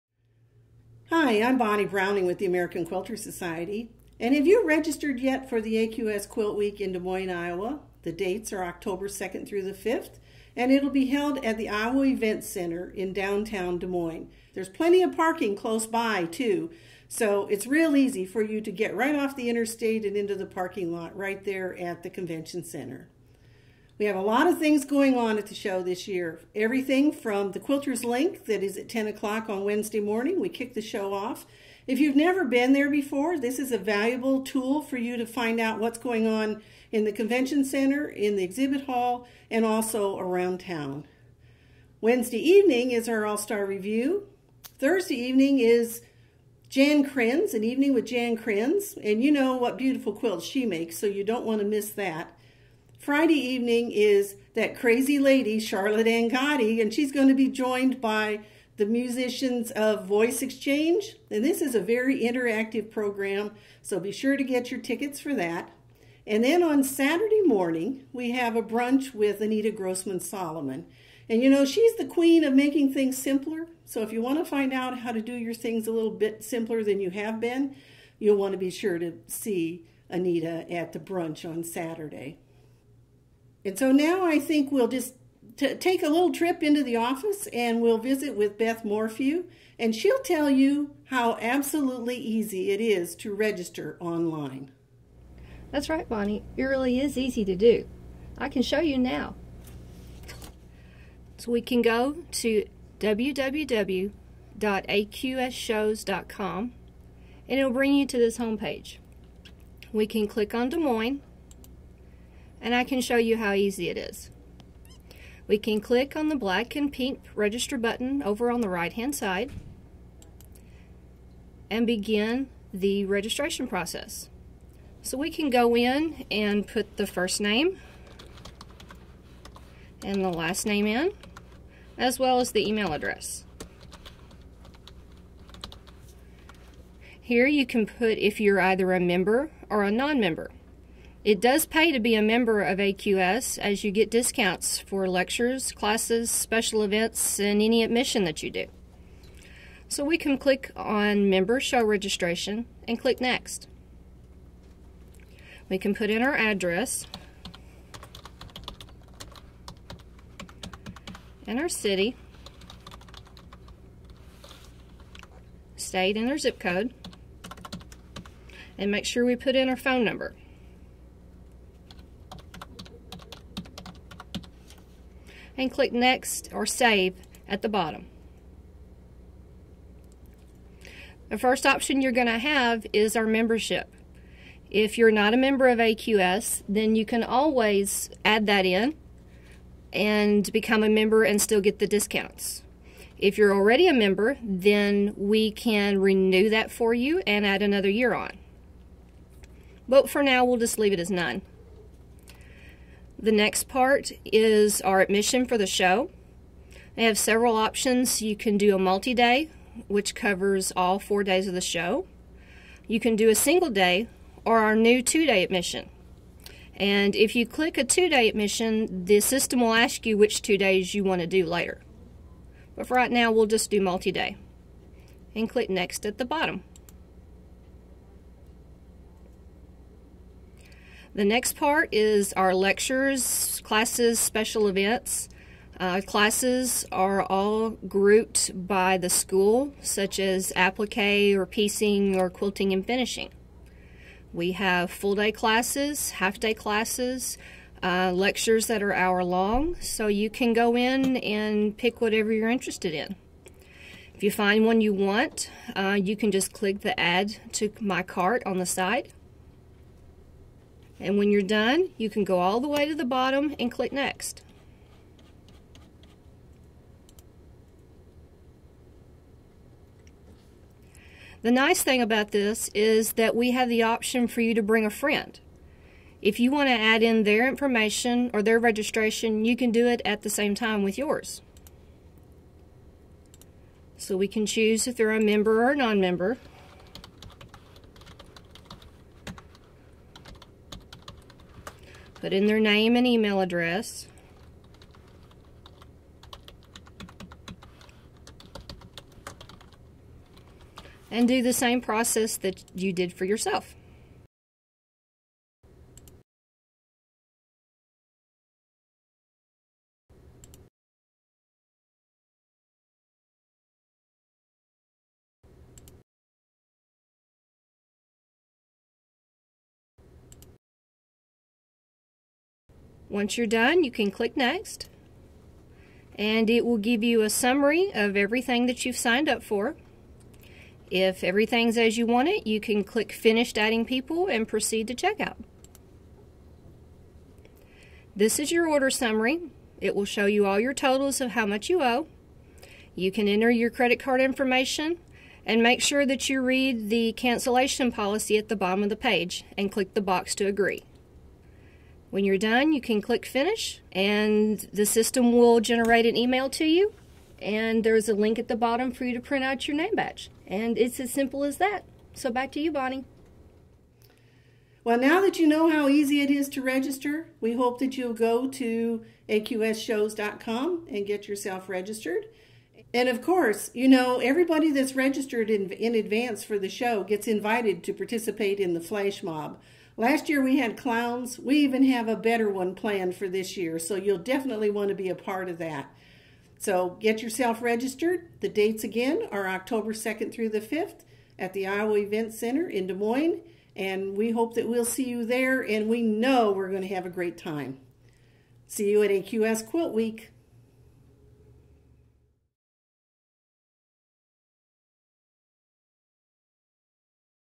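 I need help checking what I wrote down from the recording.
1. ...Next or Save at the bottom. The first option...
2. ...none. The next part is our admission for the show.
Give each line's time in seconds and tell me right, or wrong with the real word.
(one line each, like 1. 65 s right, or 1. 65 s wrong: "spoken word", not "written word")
1. 175 s right
2. 201 s right.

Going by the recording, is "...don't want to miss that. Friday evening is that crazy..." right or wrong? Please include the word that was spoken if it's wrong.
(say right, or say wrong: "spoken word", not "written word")
right.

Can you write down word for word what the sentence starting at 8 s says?
The dates are October 2nd through the 5th, and it'll be held at the Iowa Event Center in downtown Des Moines.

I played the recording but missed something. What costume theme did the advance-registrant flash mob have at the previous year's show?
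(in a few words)
clowns.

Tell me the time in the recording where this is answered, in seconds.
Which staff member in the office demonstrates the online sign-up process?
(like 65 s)
88 s.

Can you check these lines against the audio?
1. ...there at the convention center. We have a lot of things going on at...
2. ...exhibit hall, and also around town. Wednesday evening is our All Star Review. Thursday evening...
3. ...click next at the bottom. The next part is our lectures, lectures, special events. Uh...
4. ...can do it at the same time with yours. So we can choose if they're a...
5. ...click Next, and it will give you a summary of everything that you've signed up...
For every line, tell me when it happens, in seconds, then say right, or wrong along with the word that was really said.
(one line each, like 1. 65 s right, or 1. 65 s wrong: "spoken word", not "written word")
1. 21 s right
2. 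38 s right
3. 225 s wrong: "classes", not "lectures"
4. 279 s right
5. 324 s right.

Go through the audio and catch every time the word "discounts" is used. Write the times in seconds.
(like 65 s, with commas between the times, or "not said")
144 s, 191 s.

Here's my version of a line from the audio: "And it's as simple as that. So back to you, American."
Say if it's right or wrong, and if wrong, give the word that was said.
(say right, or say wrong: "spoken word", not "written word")
wrong: "Bonnie", not "American".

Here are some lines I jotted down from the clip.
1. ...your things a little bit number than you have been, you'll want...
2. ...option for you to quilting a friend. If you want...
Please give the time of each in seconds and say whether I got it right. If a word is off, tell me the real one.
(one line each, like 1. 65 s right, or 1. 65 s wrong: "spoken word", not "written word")
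1. 75 s wrong: "simpler", not "number"
2. 273 s wrong: "bring", not "quilting".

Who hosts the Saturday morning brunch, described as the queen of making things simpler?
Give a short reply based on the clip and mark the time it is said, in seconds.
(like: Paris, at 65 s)
Anita Grossman Solomon, at 69 s.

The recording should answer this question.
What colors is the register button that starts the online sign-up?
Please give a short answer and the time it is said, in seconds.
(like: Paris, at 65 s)
black and pink, at 116 s.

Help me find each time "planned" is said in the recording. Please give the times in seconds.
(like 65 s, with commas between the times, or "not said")
382 s.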